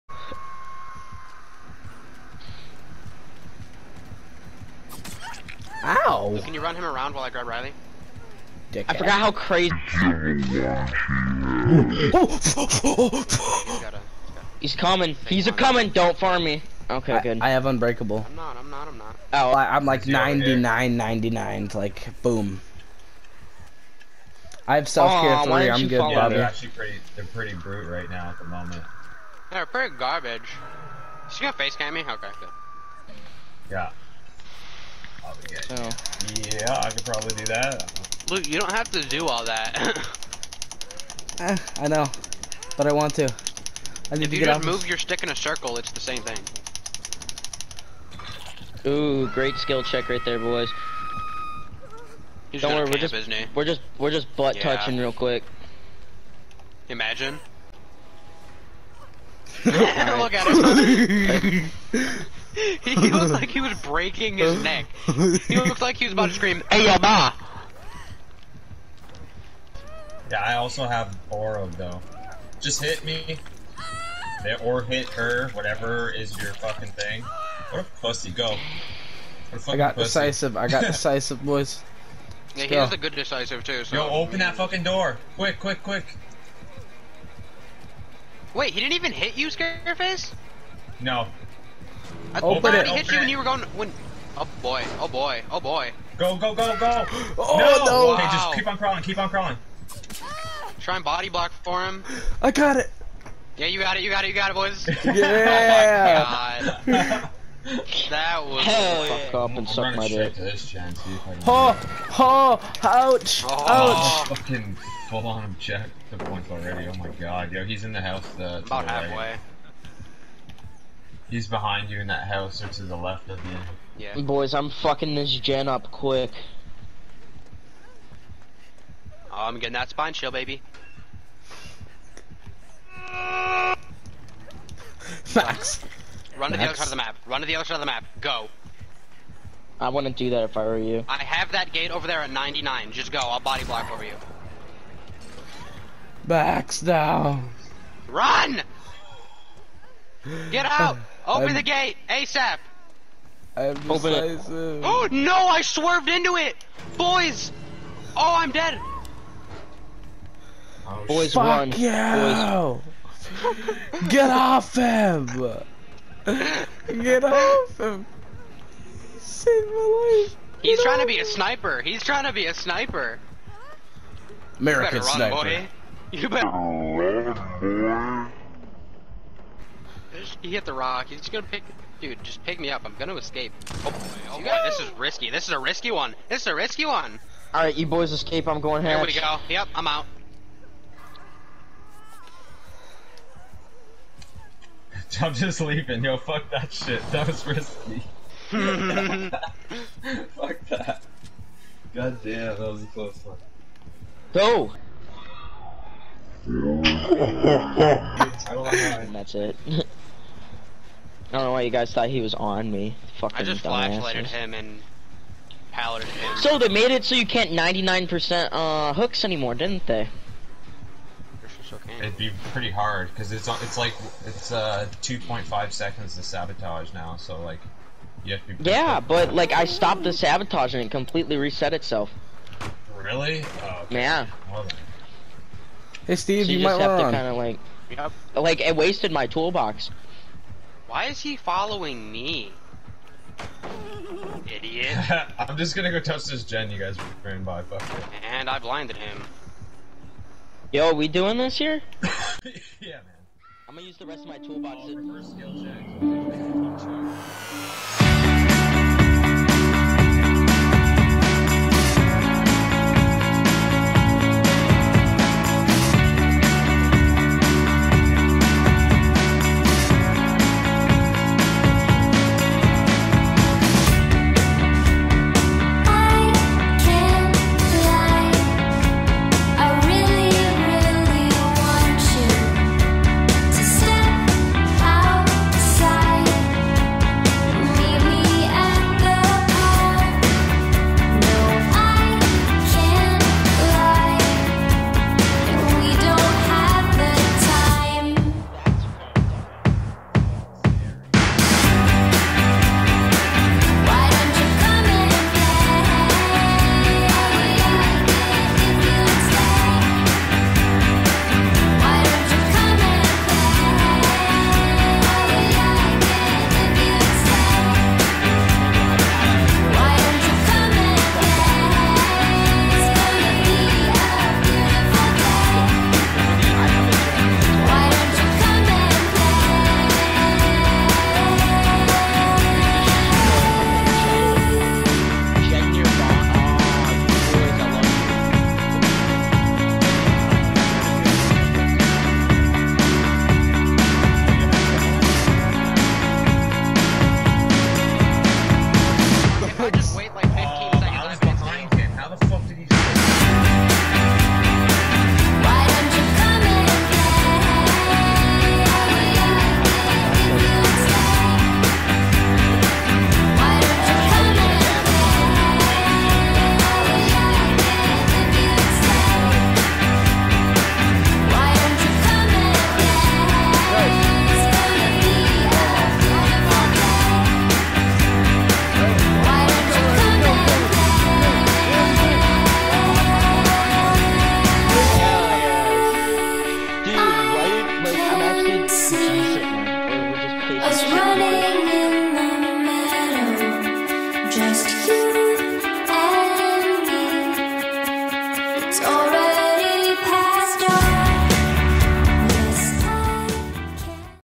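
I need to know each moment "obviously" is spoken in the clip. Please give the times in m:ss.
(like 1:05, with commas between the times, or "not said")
not said.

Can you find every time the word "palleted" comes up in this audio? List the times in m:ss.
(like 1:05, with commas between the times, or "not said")
3:35.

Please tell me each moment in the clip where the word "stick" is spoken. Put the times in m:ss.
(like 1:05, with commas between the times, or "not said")
0:44.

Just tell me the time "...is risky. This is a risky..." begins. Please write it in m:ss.
3:04.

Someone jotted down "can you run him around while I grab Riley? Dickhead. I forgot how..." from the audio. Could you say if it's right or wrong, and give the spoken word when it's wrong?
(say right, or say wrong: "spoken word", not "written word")
right.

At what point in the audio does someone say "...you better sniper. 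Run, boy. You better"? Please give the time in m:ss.
2:54.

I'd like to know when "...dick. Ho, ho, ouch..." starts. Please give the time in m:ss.
1:50.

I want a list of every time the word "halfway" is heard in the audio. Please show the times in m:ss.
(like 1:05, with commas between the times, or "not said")
1:58.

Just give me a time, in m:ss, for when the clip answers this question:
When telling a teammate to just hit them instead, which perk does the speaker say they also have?
1:11.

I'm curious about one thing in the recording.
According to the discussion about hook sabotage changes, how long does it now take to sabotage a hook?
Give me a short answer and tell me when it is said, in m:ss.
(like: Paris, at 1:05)
2.5 seconds, at 3:45.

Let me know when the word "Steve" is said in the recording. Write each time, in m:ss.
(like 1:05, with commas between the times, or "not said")
3:56.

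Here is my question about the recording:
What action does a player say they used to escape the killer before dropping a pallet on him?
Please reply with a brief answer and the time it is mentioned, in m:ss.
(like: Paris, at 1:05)
Flashlighted, at 3:33.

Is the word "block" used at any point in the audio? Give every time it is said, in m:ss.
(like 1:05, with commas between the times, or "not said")
1:41, 2:23.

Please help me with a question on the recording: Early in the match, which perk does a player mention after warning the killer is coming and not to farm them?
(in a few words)
Unbreakable.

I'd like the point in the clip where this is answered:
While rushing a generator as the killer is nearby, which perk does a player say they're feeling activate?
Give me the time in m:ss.
2:09.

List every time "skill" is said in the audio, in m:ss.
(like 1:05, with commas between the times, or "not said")
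0:49.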